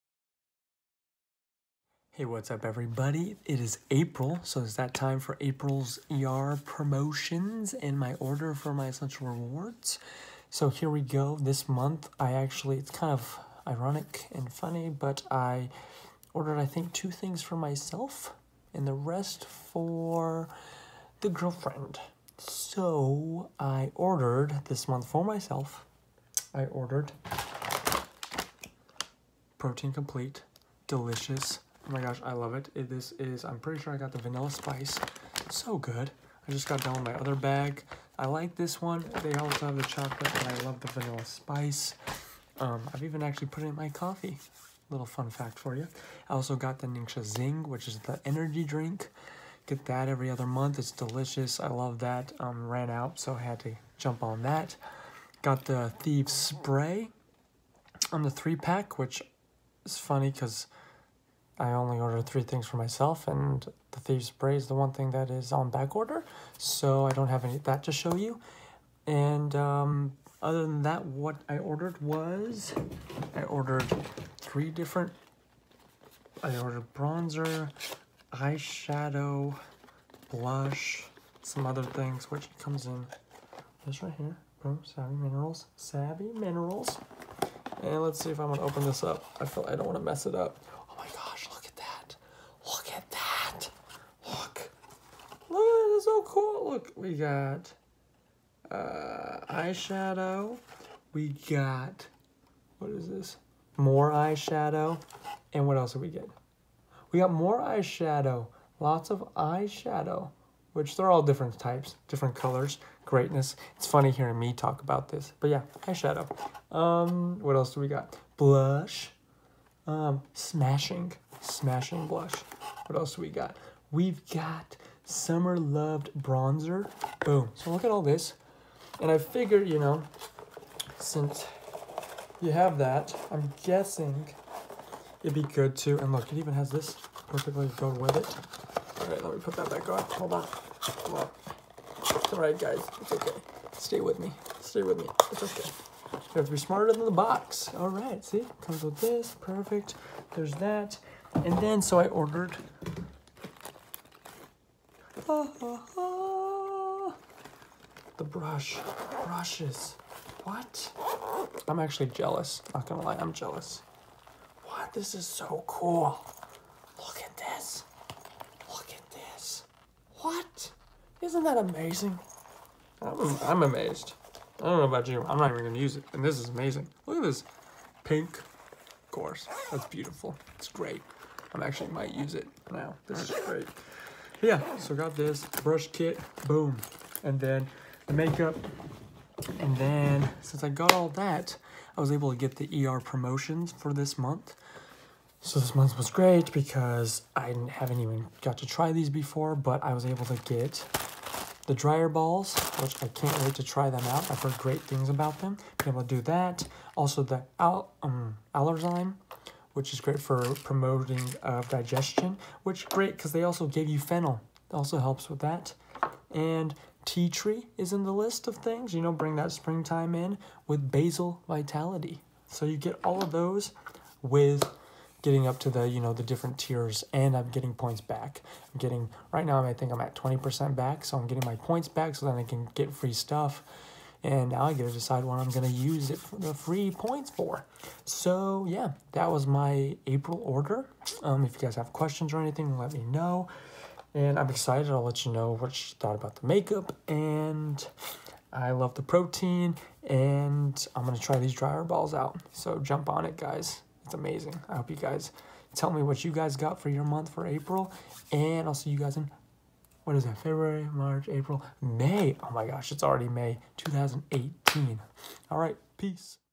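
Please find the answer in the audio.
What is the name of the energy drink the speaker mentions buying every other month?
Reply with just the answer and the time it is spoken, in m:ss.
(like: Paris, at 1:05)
Ningxia Zing, at 0:46.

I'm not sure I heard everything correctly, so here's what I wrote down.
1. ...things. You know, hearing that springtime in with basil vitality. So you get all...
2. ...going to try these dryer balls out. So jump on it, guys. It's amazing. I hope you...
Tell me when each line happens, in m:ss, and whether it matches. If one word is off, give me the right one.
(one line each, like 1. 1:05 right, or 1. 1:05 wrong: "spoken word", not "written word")
1. 3:38 wrong: "bring", not "hearing"
2. 4:11 right.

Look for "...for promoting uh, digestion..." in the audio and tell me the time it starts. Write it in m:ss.
3:30.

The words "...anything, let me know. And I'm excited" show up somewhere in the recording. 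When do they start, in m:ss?
4:02.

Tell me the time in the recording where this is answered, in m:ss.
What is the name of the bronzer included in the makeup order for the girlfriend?
2:05.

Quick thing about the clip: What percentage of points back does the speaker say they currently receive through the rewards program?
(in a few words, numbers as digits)
20%.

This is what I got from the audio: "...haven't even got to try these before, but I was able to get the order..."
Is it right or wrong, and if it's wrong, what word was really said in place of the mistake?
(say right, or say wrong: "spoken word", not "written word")
wrong: "dryer", not "order".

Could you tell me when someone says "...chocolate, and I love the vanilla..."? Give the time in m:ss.
0:39.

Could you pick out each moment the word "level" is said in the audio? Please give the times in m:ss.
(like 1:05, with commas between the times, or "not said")
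not said.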